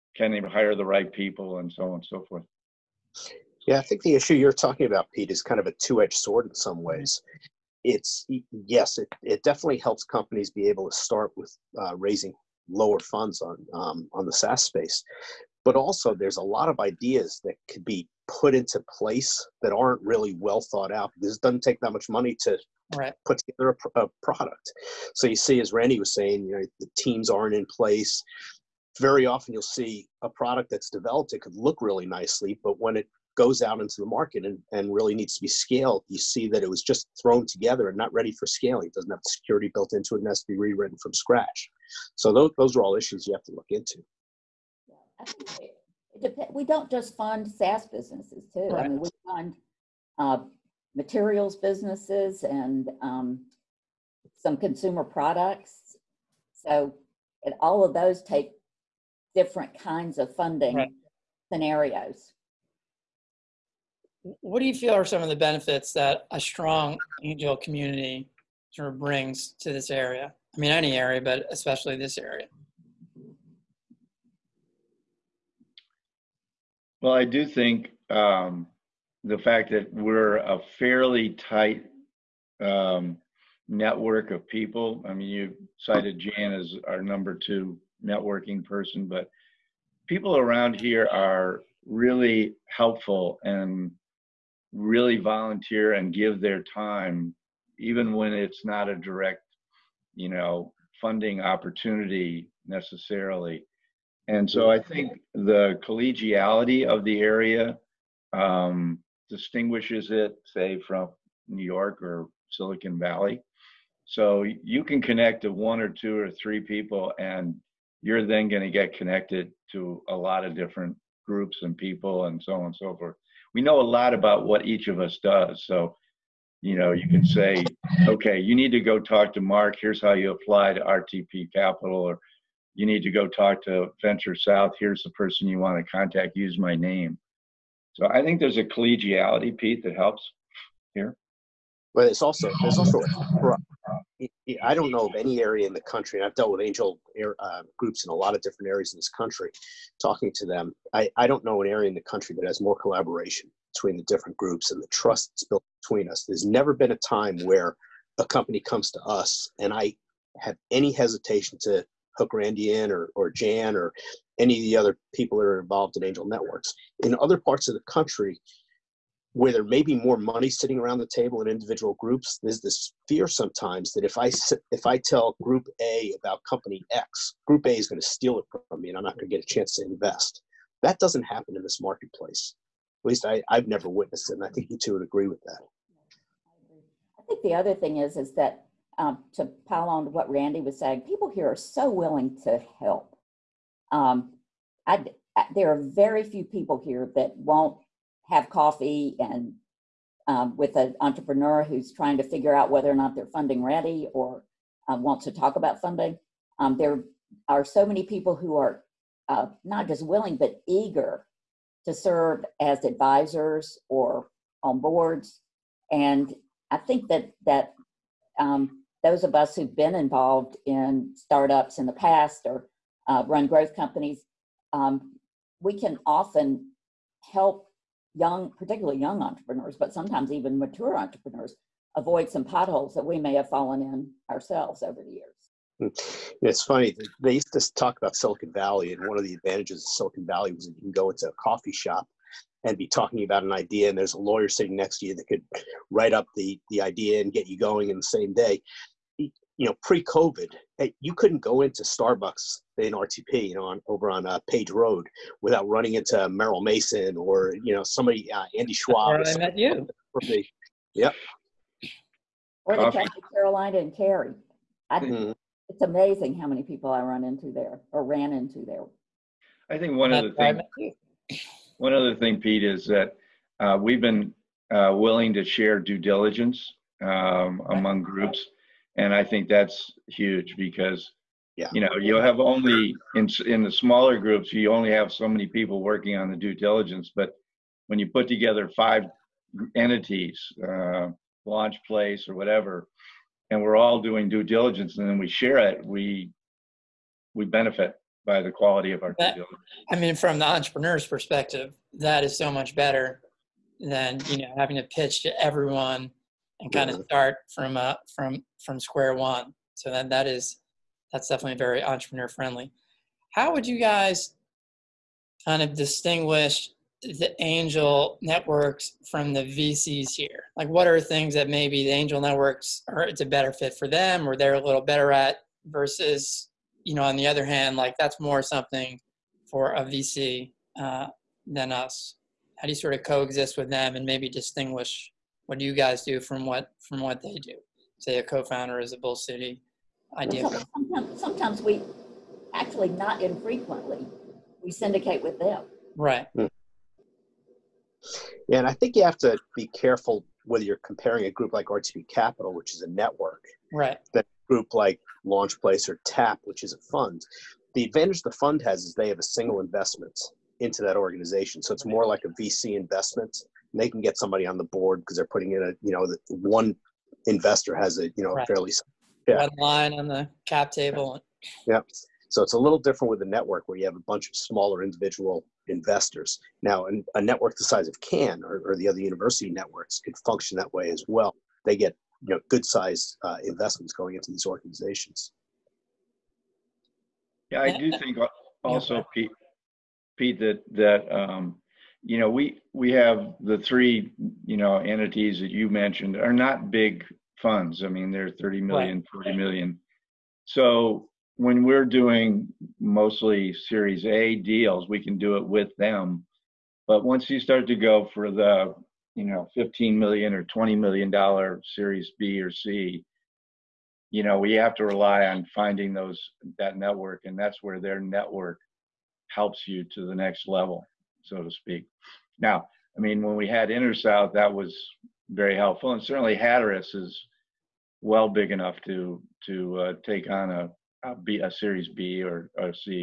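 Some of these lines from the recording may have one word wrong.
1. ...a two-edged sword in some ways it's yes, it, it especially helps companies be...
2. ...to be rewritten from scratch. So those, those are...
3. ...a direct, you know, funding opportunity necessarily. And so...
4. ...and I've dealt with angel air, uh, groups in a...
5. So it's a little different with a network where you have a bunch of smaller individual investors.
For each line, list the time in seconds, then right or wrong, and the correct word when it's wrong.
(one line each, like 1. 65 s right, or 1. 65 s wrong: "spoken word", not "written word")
1. 5 s wrong: "definitely", not "especially"
2. 40 s right
3. 98 s right
4. 146 s right
5. 372 s right.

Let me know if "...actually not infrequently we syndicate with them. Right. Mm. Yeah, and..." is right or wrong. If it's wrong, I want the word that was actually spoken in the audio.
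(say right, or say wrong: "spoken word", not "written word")
right.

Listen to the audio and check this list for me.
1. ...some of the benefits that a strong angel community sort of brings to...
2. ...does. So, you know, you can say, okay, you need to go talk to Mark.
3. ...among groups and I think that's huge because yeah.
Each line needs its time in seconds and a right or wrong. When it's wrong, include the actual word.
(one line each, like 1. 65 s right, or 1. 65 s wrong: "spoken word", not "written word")
1. 65 s right
2. 125 s right
3. 277 s right.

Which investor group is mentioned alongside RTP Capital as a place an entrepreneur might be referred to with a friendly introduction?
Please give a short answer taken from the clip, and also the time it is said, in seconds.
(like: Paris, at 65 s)
Venture South, at 134 s.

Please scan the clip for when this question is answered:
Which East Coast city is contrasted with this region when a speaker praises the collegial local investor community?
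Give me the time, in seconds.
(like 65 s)
111 s.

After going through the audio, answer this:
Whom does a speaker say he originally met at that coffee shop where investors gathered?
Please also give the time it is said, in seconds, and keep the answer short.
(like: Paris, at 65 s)
Andy Schwab, at 258 s.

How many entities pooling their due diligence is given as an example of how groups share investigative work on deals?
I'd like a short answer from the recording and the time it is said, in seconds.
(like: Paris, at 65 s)
5, at 288 s.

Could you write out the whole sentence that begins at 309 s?
So that that is that's definitely very entrepreneur friendly.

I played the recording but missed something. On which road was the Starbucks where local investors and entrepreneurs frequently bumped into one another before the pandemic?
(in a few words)
Page Road.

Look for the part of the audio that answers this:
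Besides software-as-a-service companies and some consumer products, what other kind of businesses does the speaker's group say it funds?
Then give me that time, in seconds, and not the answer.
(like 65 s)
50 s.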